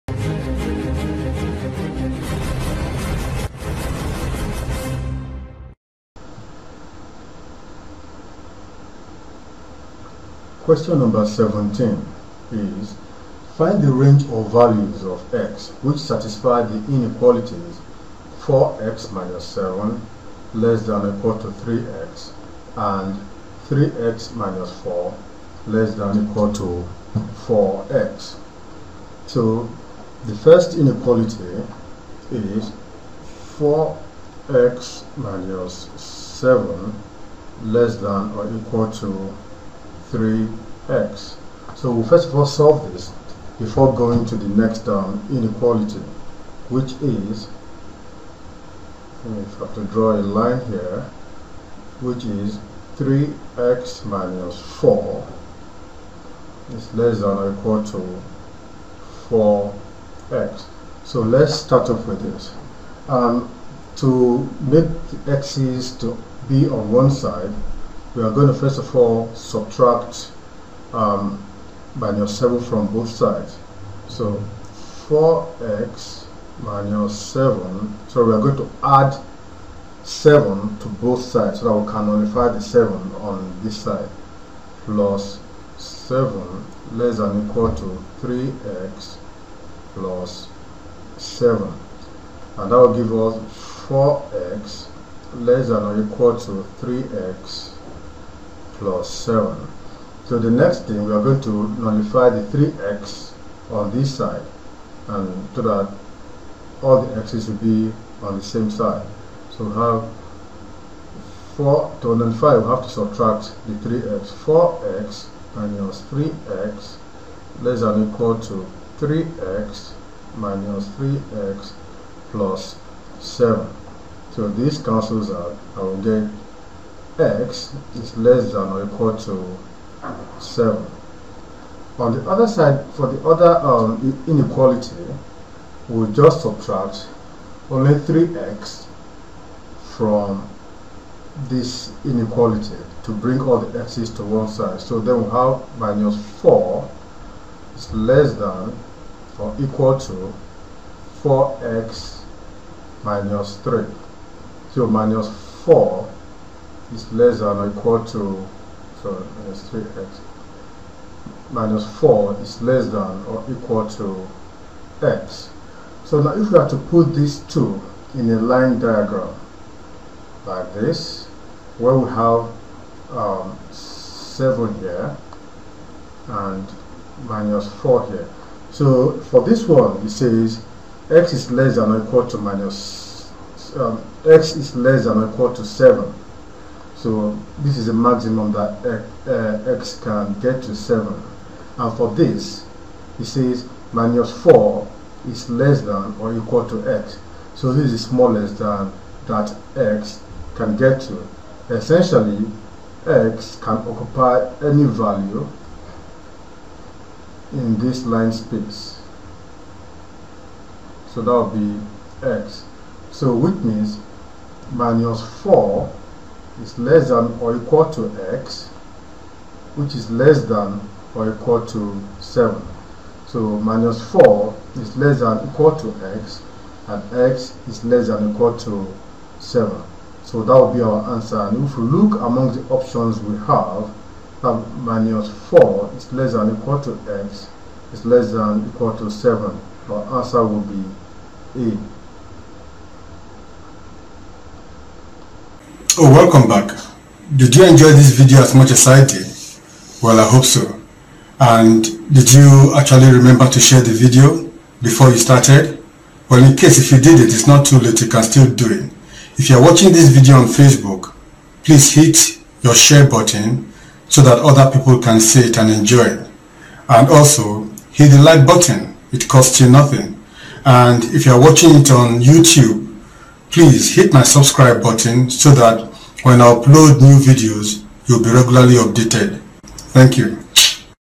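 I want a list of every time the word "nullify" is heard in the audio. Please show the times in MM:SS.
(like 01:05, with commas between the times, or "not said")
01:22, 01:41, 01:52.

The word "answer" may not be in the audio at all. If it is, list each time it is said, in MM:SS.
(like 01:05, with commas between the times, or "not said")
03:51, 04:00.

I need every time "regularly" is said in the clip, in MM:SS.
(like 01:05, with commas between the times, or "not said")
04:38.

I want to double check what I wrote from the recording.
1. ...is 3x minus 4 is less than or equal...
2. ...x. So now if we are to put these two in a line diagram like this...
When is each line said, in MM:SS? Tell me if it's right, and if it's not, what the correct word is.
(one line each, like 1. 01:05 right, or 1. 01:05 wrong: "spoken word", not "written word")
1. 00:52 right
2. 02:45 right.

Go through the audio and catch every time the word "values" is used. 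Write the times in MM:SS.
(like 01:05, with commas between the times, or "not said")
00:14, 03:24.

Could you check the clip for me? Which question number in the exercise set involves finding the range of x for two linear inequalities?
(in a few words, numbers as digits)
17.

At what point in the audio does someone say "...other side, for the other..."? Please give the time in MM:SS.
02:12.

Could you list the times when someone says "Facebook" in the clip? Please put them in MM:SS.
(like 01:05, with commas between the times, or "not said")
04:20.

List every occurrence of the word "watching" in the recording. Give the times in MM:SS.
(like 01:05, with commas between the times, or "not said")
04:19, 04:31.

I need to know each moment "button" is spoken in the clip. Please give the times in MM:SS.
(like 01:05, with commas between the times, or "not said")
04:23, 04:28, 04:34.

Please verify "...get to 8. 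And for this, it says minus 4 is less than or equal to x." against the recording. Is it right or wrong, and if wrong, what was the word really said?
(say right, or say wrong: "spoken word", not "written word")
wrong: "7", not "8".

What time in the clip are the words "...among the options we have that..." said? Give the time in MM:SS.
03:52.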